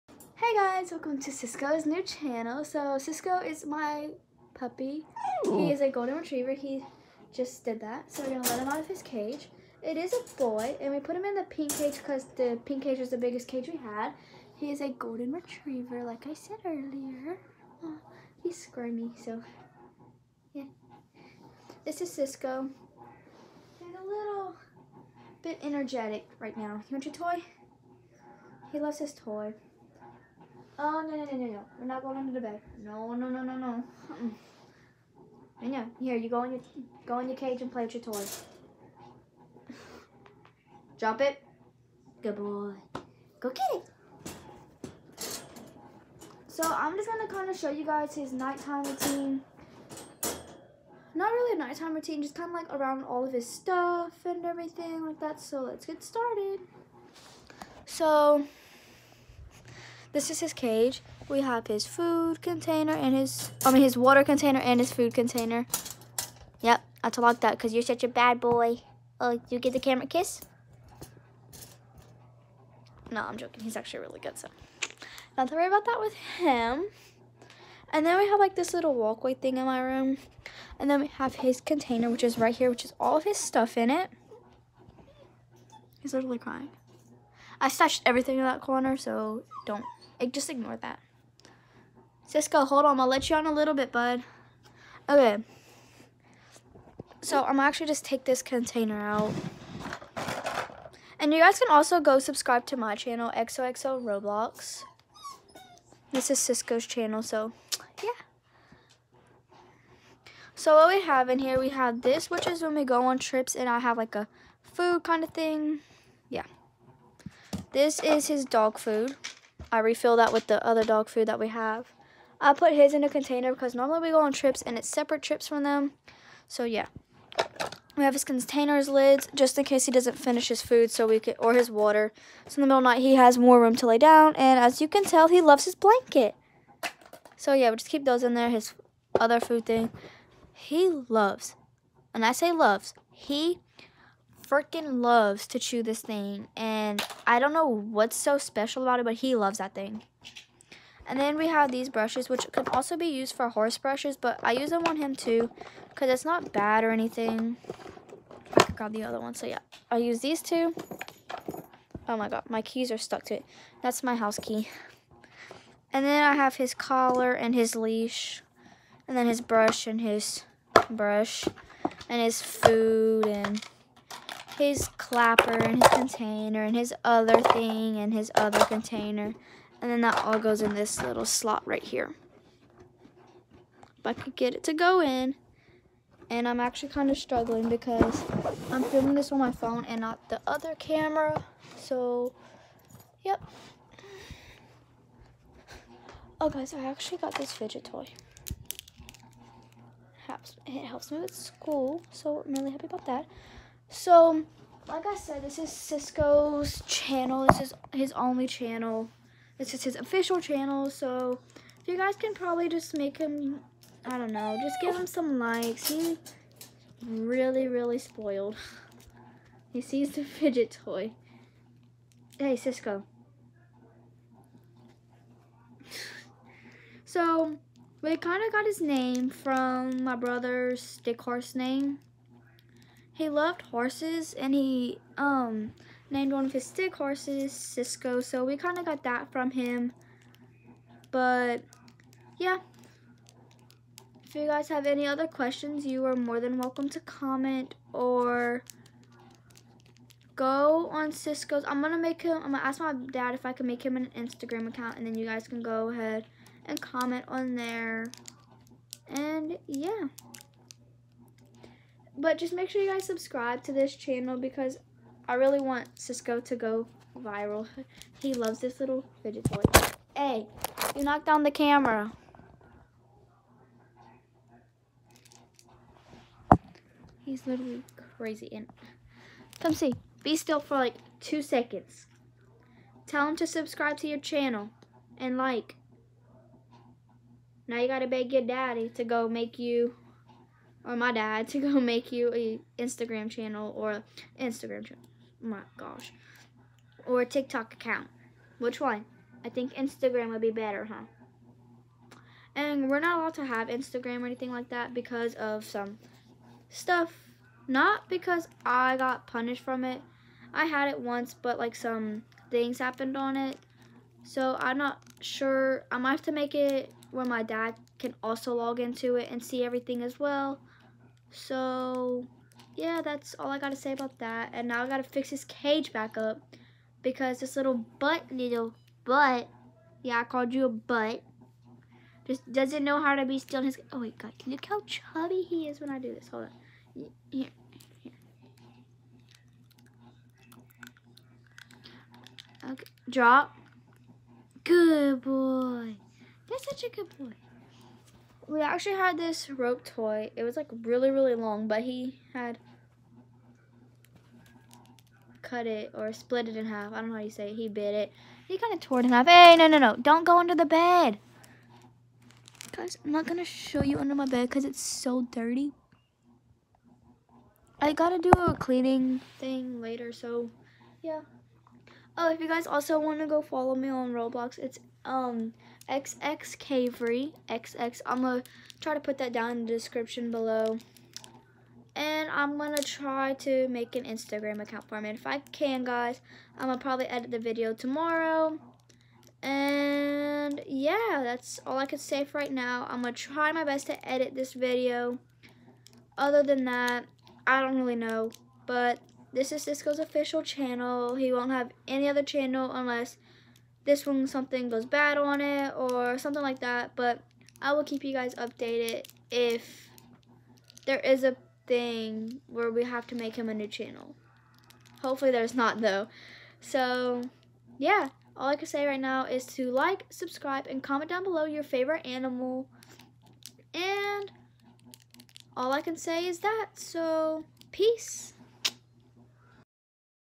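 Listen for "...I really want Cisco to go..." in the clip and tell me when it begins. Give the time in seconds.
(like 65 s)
265 s.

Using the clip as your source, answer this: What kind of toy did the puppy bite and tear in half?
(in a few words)
Rope toy.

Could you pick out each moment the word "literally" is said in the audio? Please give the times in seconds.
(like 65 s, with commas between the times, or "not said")
86 s, 277 s.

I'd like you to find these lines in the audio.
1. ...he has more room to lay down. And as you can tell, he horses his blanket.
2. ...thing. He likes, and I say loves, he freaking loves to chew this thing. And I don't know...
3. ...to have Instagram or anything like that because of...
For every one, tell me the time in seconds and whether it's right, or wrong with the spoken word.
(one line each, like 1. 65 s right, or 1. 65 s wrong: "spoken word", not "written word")
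1. 133 s wrong: "loves", not "horses"
2. 139 s wrong: "loves", not "likes"
3. 303 s right.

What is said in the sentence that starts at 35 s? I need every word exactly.
Here, you go in your go in your cage and play with your toys.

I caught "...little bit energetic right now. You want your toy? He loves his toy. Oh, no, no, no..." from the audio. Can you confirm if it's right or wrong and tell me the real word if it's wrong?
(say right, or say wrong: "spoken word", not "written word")
right.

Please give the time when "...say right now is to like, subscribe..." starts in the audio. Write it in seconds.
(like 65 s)
418 s.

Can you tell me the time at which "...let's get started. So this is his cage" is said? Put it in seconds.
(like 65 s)
55 s.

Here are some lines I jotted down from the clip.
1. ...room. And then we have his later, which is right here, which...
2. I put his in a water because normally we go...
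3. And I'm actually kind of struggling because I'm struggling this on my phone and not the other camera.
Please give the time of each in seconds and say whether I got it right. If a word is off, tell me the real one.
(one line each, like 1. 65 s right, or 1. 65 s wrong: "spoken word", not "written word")
1. 79 s wrong: "container", not "later"
2. 122 s wrong: "container", not "water"
3. 186 s wrong: "filming", not "struggling".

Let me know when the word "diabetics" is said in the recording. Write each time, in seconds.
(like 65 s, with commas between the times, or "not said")
not said.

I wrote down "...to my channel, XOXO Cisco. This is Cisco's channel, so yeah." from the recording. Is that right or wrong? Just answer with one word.
wrong.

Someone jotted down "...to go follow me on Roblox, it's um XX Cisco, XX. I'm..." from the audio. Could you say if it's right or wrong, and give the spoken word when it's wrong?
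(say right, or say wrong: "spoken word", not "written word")
wrong: "Cavery", not "Cisco".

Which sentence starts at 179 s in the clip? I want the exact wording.
And then that all goes in this little slot right here.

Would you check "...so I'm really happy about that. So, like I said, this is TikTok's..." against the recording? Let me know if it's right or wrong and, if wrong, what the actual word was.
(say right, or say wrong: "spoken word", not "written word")
wrong: "Cisco", not "TikTok".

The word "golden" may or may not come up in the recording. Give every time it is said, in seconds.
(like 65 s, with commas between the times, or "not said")
5 s, 14 s.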